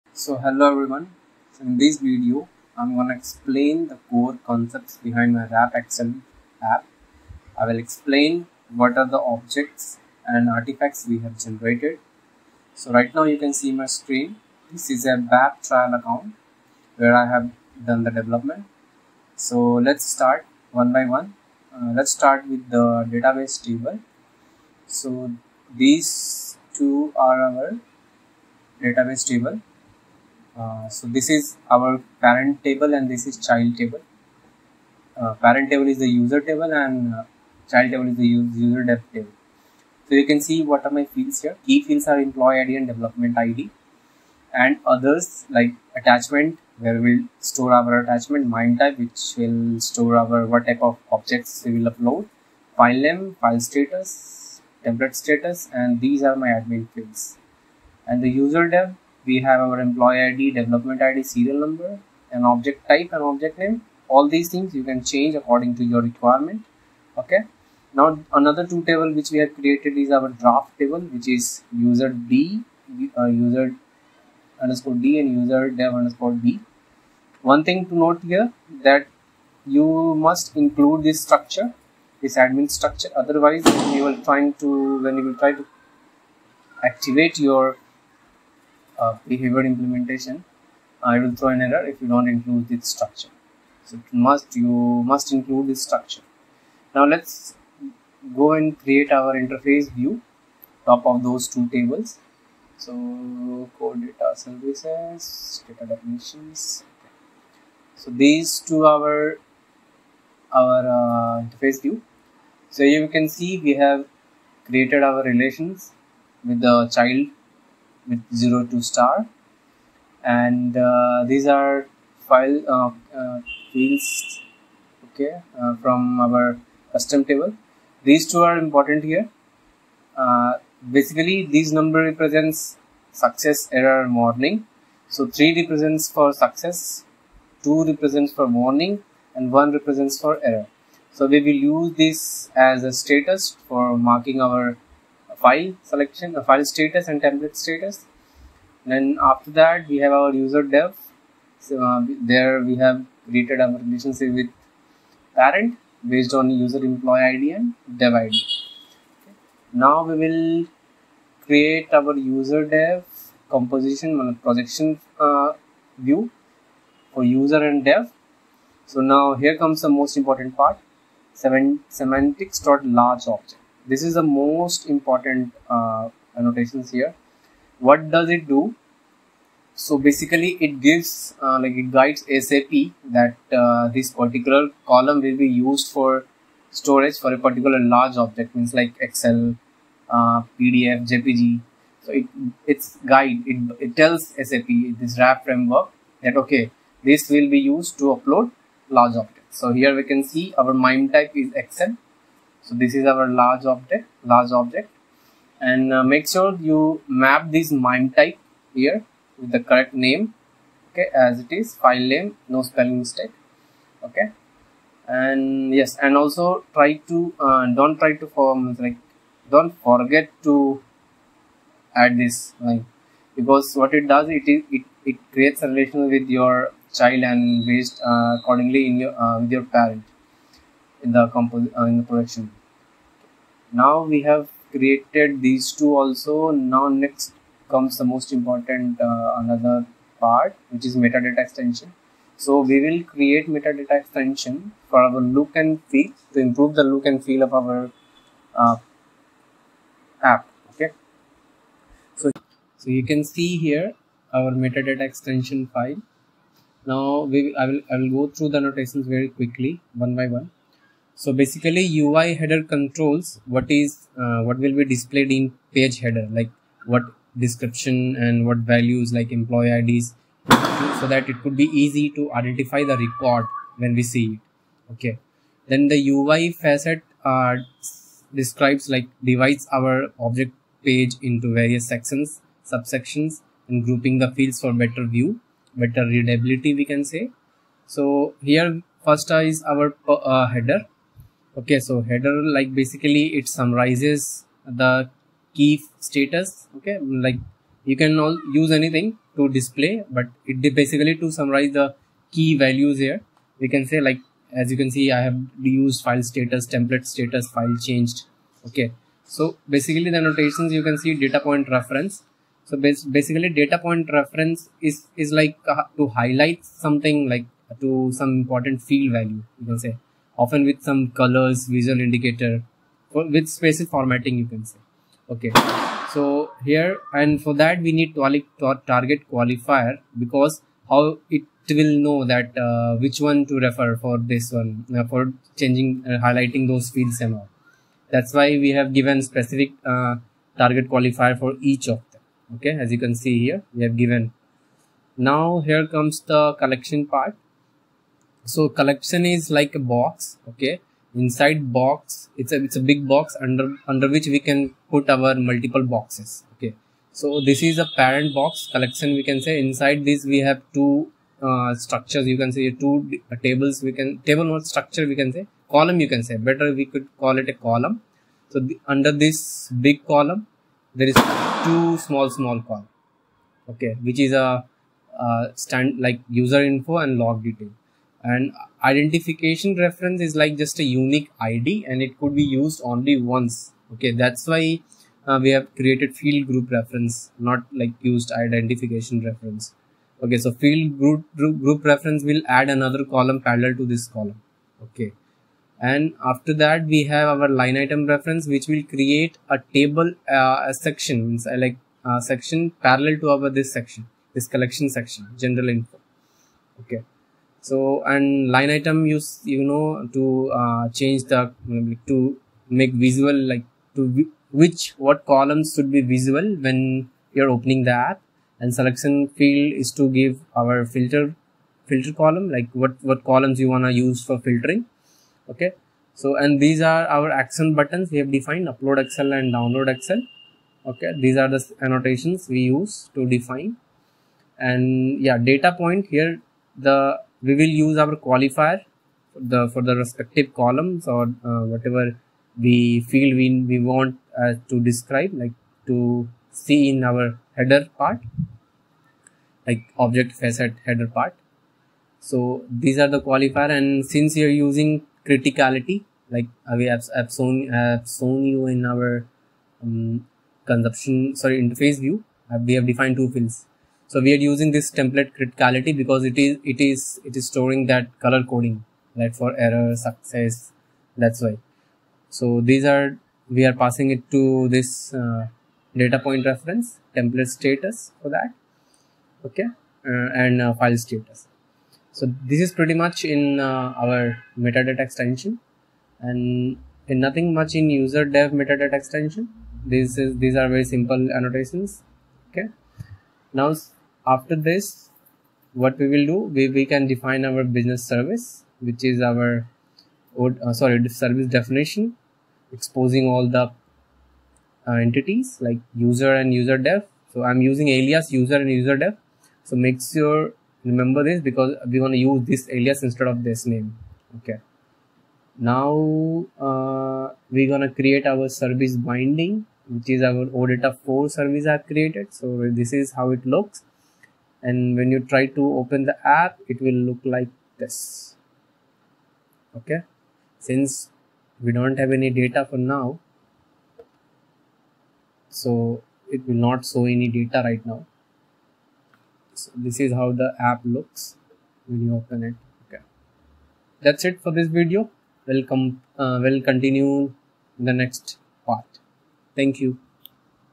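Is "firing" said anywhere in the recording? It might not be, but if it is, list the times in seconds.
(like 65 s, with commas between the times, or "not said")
not said.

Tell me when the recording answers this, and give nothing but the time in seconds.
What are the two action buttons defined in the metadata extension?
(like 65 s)
428 s.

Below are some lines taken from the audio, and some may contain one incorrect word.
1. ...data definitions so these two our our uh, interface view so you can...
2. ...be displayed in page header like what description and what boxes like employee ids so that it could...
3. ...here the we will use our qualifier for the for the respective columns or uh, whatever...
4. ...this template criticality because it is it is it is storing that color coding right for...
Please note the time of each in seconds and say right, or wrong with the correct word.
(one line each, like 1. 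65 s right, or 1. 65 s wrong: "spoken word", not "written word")
1. 105 s right
2. 264 s wrong: "values", not "boxes"
3. 436 s right
4. 464 s right.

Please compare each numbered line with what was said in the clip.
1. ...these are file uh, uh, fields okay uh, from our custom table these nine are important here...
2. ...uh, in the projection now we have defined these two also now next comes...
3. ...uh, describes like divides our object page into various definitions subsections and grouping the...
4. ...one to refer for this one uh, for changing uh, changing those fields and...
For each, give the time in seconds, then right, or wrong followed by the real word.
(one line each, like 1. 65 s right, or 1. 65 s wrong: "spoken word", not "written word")
1. 121 s wrong: "two", not "nine"
2. 231 s wrong: "created", not "defined"
3. 277 s wrong: "sections", not "definitions"
4. 333 s wrong: "highlighting", not "changing".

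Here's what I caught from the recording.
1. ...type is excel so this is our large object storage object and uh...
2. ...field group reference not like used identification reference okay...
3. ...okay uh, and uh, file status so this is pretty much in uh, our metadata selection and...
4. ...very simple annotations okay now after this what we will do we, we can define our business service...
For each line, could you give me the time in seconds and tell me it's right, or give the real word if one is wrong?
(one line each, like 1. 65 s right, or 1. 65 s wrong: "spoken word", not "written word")
1. 201 s wrong: "large", not "storage"
2. 386 s right
3. 479 s wrong: "extension", not "selection"
4. 490 s right.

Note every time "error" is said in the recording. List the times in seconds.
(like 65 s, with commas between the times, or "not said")
91 s, 133 s, 140 s, 469 s.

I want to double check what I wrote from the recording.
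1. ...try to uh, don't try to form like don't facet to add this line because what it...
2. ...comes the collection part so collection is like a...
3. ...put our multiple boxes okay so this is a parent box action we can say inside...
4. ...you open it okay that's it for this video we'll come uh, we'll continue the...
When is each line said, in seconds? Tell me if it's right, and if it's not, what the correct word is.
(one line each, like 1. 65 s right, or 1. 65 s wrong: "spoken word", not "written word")
1. 216 s wrong: "forget", not "facet"
2. 345 s right
3. 354 s wrong: "collection", not "action"
4. 542 s right.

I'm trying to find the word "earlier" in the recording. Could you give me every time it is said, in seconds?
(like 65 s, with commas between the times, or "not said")
not said.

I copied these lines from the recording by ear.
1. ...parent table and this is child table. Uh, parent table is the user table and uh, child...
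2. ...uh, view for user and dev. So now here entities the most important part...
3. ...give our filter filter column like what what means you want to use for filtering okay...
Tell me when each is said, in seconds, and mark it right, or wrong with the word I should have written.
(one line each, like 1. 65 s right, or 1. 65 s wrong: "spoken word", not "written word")
1. 32 s right
2. 165 s wrong: "comes", not "entities"
3. 420 s wrong: "columns", not "means".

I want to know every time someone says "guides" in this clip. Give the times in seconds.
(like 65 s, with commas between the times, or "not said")
181 s, 193 s.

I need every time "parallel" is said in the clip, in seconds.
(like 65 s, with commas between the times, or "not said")
393 s, 402 s.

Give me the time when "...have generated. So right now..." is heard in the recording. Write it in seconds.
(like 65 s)
11 s.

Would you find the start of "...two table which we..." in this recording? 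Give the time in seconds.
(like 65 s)
68 s.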